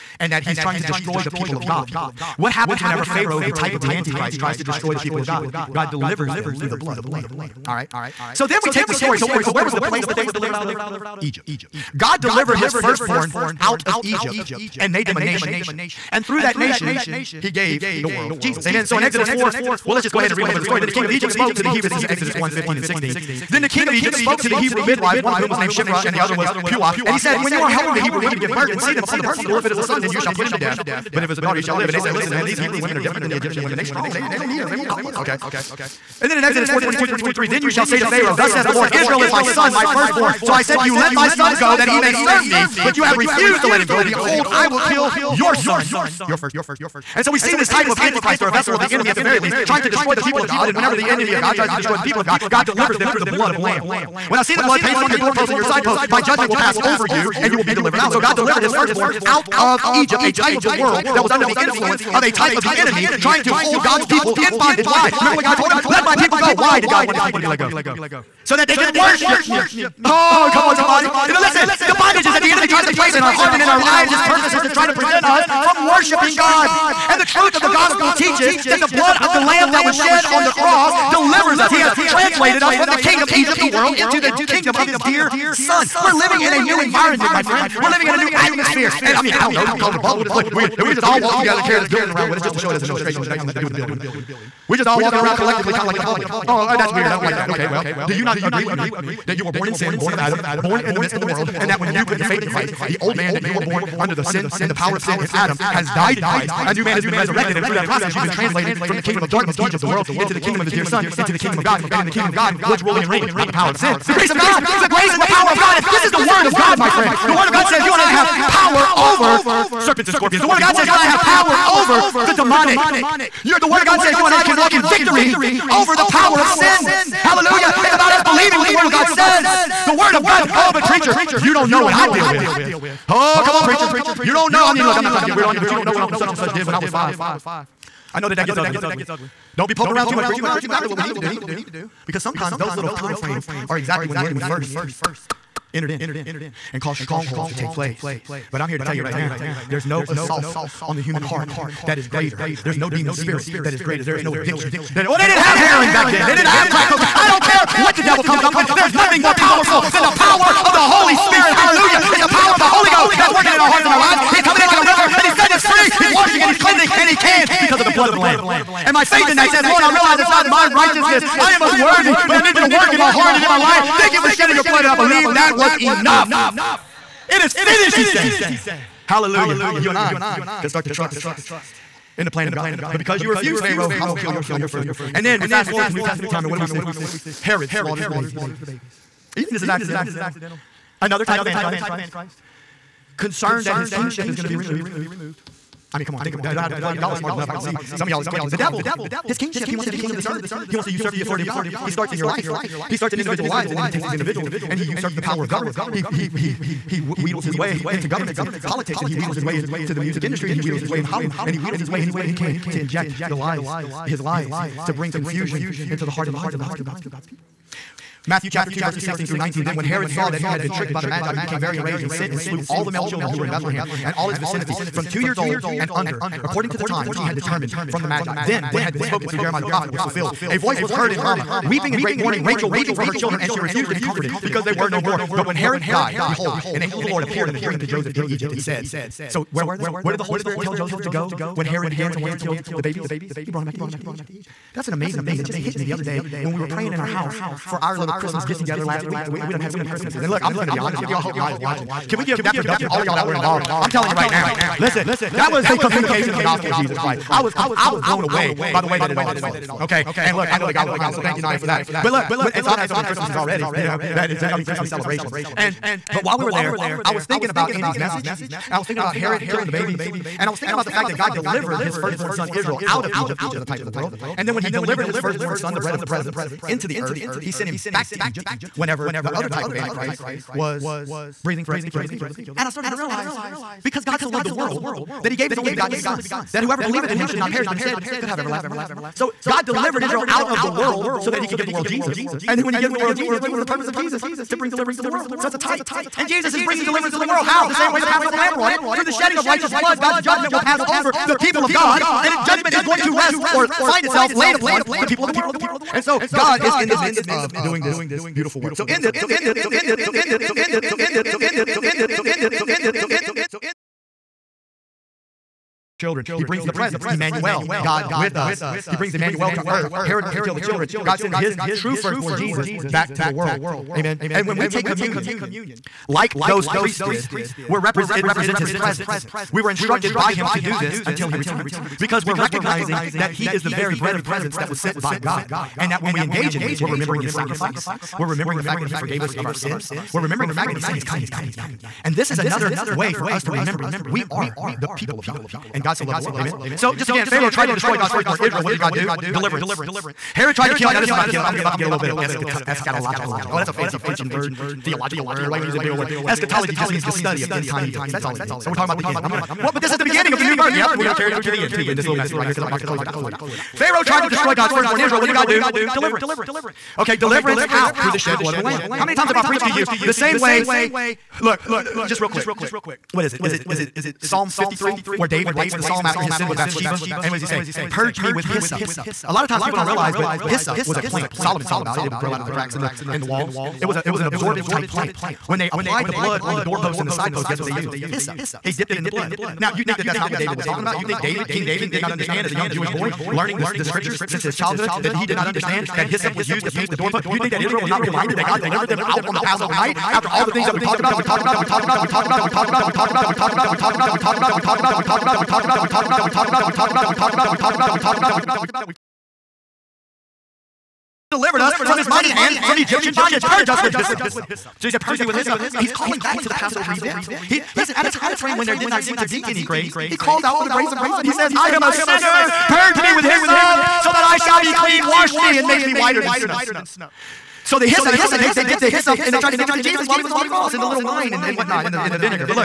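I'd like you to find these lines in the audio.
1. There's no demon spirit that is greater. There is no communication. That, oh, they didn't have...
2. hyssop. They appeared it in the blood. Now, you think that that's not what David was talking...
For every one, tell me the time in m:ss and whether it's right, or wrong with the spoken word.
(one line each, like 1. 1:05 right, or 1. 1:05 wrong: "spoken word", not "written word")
1. 2:32 wrong: "addiction", not "communication"
2. 6:28 wrong: "dipped", not "appeared".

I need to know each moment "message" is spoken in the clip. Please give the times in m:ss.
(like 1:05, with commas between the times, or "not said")
4:27, 6:02.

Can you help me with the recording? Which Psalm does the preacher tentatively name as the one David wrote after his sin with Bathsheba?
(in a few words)
Psalm 53.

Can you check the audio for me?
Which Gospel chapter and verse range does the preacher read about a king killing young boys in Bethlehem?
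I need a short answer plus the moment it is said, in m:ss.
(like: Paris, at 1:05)
Matthew 2:16-19, at 3:38.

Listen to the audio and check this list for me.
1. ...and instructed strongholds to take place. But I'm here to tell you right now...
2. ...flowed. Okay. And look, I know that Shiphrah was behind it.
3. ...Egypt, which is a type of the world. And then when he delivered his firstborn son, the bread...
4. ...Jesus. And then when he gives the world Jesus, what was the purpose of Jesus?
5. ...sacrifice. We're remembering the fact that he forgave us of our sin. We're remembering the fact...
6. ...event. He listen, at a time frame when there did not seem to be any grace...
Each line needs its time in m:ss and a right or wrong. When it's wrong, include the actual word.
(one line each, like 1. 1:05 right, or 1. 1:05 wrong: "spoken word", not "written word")
1. 2:26 wrong: "caused", not "instructed"
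2. 4:19 wrong: "God", not "Shiphrah"
3. 4:33 right
4. 4:51 right
5. 5:37 right
6. 6:56 right.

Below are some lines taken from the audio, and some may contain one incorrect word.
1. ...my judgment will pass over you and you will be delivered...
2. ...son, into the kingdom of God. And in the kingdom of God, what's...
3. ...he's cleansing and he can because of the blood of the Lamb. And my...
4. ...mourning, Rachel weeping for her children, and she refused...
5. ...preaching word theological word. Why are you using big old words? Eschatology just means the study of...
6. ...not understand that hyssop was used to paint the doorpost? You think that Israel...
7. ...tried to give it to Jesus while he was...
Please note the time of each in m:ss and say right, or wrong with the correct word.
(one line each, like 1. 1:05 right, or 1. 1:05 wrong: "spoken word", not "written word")
1. 0:56 right
2. 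1:50 right
3. 2:46 right
4. 3:52 right
5. 5:53 right
6. 6:35 right
7. 7:09 right.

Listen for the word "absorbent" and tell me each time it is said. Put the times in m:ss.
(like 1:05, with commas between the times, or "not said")
6:24.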